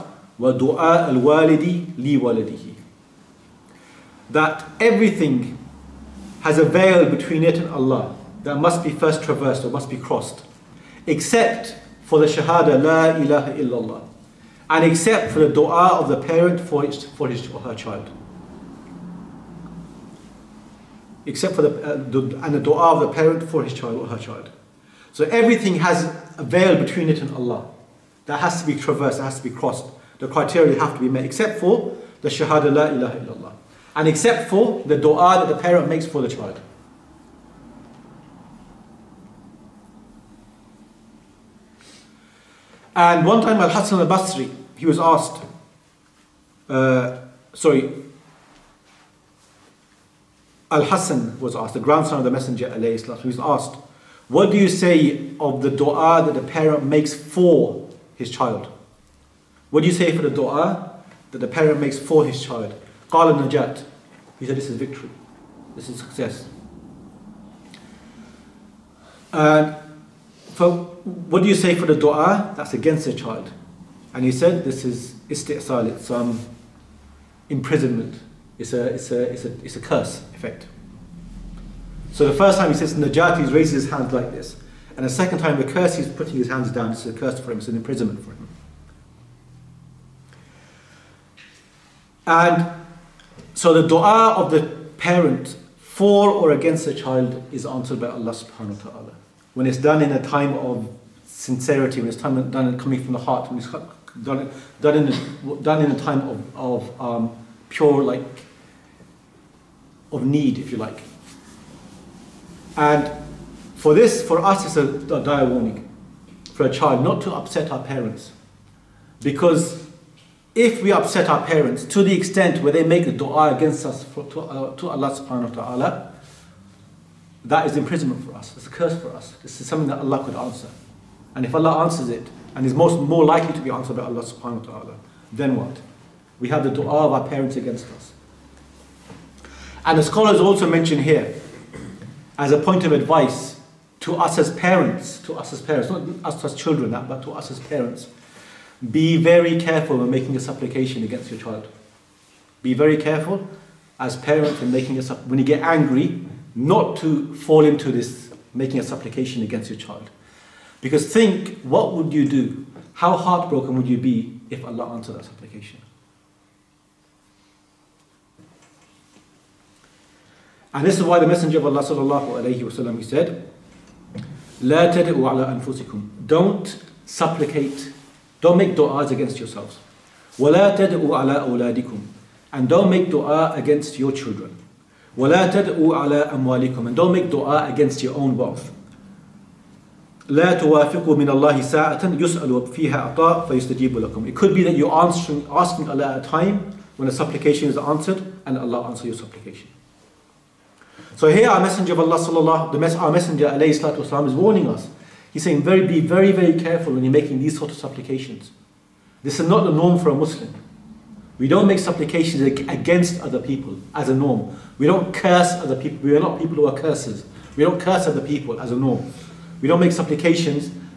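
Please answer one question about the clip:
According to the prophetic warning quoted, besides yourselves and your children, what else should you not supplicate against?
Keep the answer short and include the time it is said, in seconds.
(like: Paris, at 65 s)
Your own wealth, at 188 s.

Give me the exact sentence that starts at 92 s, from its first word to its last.
And so the dua of the parent for or against the child is answered by Allah subhanahu wa ta'ala.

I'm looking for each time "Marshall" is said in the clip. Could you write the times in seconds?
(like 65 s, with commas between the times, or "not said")
not said.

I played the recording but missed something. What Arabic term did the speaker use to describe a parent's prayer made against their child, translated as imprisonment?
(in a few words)
Isti'sal.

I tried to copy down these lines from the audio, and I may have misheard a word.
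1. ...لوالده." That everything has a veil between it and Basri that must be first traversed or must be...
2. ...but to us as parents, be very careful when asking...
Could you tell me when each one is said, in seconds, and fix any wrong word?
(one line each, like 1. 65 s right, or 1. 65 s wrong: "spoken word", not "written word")
1. 1 s wrong: "Allah", not "Basri"
2. 146 s wrong: "making", not "asking".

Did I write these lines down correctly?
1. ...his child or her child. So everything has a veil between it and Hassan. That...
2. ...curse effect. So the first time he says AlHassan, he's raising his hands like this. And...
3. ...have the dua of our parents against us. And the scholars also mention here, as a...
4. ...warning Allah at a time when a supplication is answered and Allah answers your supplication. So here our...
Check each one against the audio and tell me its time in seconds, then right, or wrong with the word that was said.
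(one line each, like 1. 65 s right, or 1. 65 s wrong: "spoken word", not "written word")
1. 23 s wrong: "Allah", not "Hassan"
2. 79 s wrong: "Najati", not "AlHassan"
3. 136 s right
4. 195 s wrong: "asking", not "warning".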